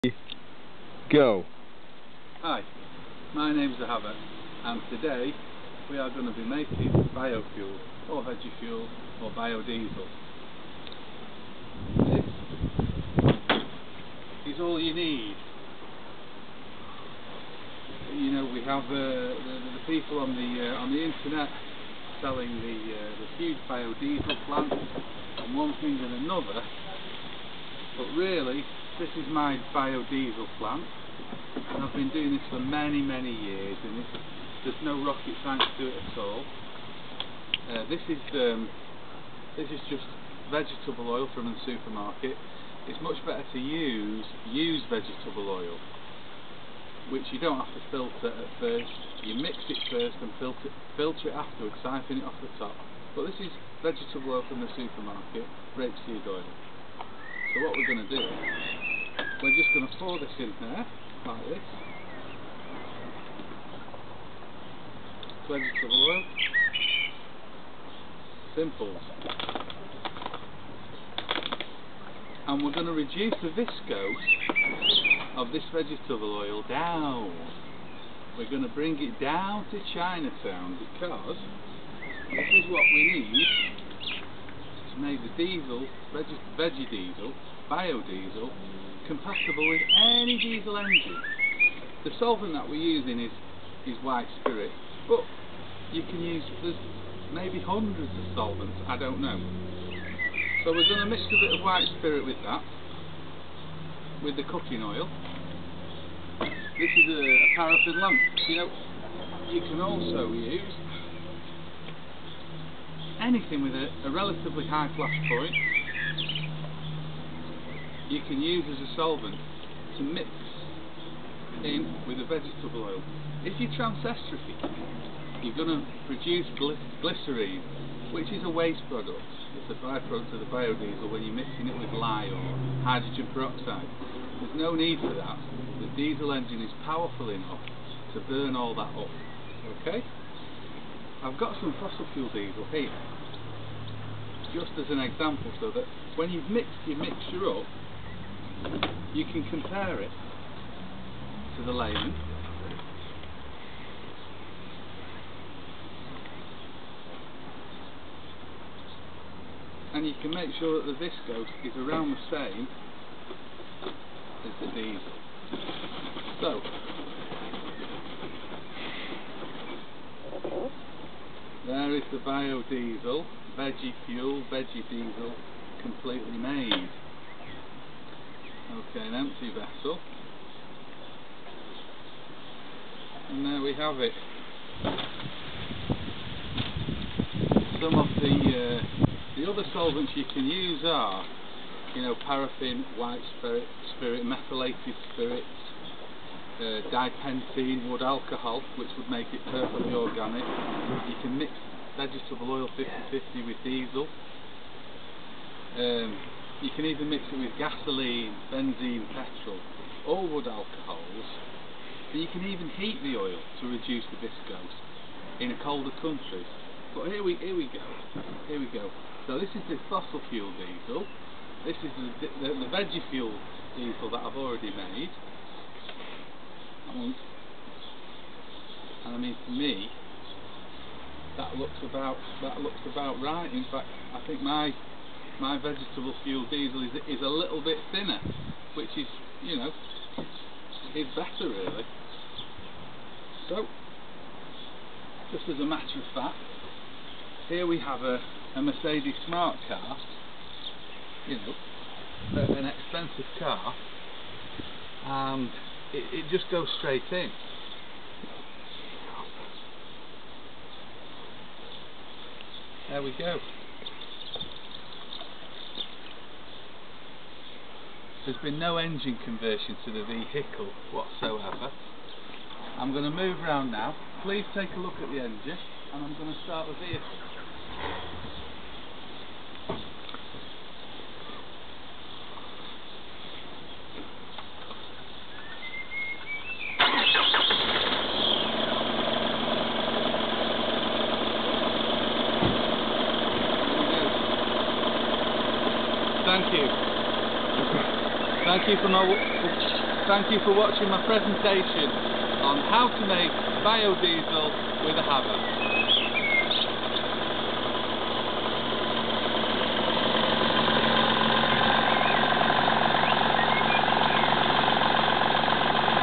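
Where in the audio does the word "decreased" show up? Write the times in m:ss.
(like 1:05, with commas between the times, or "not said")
not said.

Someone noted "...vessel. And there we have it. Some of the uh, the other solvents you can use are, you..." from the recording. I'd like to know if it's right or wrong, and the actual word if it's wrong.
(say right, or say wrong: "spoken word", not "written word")
right.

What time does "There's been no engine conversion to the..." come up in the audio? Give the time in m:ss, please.
4:28.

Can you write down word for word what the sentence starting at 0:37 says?
Uh, this is um, this is just vegetable oil from the supermarket.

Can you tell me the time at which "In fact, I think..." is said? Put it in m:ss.
3:53.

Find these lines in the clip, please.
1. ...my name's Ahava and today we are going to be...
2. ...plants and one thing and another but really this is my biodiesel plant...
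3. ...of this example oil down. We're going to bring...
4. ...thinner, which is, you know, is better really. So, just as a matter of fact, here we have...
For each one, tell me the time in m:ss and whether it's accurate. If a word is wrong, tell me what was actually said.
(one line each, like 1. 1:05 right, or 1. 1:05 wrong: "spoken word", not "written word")
1. 0:03 right
2. 0:24 right
3. 1:15 wrong: "vegetable", not "example"
4. 3:57 right.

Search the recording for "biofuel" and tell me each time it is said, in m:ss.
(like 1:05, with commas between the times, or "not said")
0:07.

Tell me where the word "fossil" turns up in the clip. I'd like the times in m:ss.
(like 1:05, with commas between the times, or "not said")
2:21, 3:39.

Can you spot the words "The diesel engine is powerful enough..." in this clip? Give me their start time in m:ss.
2:15.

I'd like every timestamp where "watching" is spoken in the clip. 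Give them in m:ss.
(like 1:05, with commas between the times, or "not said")
5:00.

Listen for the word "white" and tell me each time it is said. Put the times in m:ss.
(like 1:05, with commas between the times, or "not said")
1:34, 1:41, 3:12.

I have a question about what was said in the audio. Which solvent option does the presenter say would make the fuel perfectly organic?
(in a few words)
Wood alcohol.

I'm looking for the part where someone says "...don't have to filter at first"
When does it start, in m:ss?
0:47.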